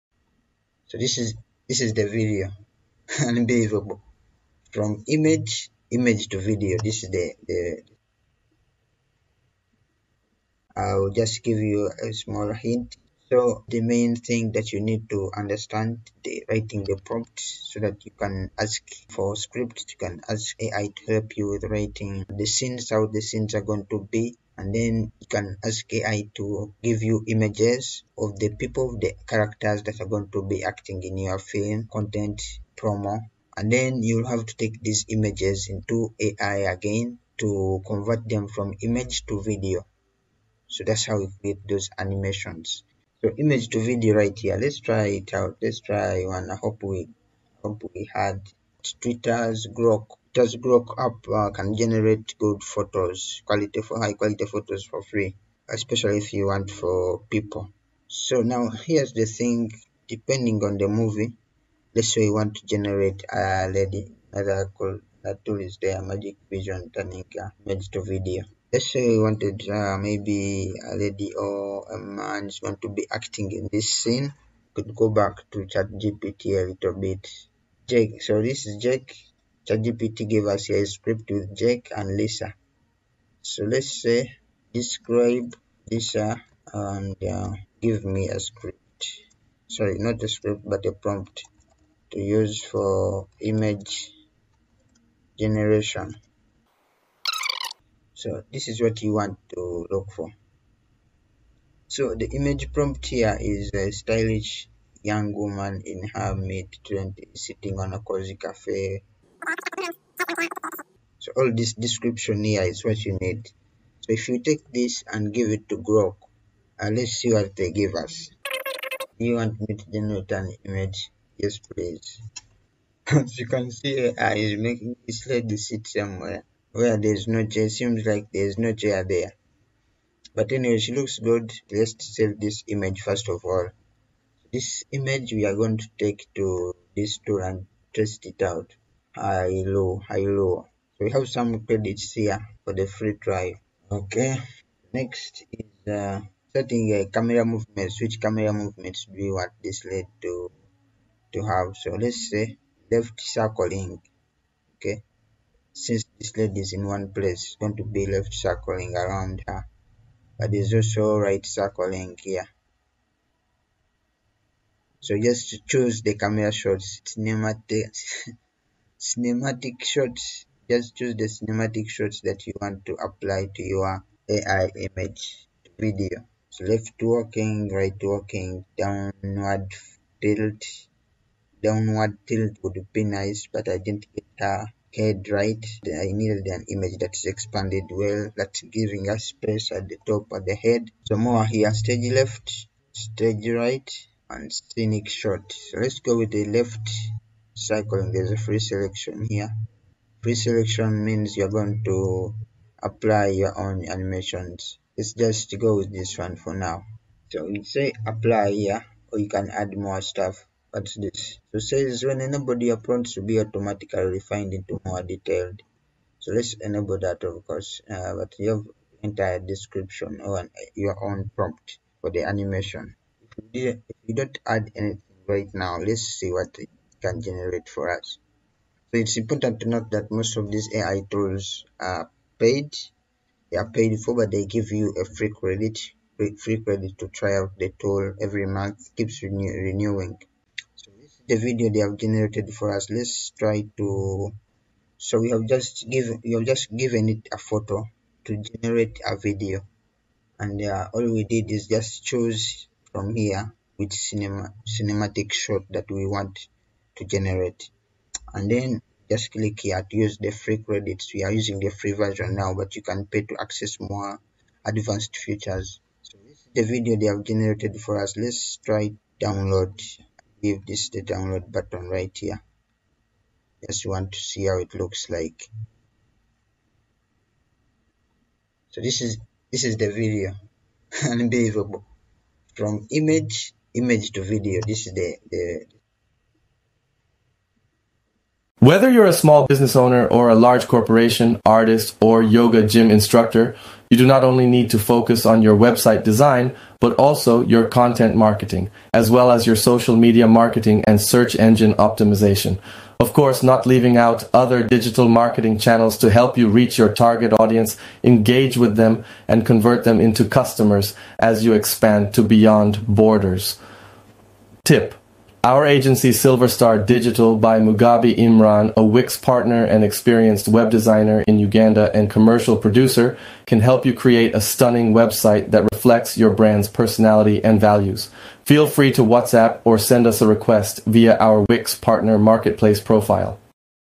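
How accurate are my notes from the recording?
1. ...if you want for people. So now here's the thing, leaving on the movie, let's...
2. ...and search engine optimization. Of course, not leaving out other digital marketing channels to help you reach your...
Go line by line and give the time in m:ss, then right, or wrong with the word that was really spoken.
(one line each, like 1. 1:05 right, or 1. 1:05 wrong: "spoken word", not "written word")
1. 0:56 wrong: "depending", not "leaving"
2. 5:00 right.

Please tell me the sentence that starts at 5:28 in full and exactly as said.
Feel free to WhatsApp or send us a request via our Wix partner marketplace profile.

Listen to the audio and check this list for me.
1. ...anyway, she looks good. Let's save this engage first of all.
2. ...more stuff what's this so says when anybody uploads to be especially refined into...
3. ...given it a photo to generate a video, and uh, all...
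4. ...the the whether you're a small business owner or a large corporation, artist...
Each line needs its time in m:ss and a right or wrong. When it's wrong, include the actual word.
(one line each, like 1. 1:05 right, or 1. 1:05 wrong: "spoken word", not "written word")
1. 2:10 wrong: "image", not "engage"
2. 3:29 wrong: "automatically", not "especially"
3. 4:06 right
4. 4:44 right.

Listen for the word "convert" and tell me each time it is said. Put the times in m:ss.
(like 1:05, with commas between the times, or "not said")
0:37, 5:09.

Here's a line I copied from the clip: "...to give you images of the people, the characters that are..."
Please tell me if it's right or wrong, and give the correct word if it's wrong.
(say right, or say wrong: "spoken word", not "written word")
right.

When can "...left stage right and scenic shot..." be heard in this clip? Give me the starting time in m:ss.
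3:12.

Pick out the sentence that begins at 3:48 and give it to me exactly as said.
So it's important to note that most of these AI tools are paid.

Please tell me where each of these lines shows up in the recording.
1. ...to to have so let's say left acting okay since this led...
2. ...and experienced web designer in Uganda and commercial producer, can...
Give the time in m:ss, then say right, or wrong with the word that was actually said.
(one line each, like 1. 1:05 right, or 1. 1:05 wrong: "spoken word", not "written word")
1. 2:30 wrong: "circling", not "acting"
2. 5:19 right.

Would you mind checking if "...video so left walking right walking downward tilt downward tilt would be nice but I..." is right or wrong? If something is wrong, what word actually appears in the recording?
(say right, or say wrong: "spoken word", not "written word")
right.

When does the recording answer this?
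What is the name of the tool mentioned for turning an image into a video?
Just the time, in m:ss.
1:06.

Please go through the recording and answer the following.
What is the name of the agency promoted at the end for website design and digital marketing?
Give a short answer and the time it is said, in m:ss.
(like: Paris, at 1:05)
Silver Star Digital, at 5:16.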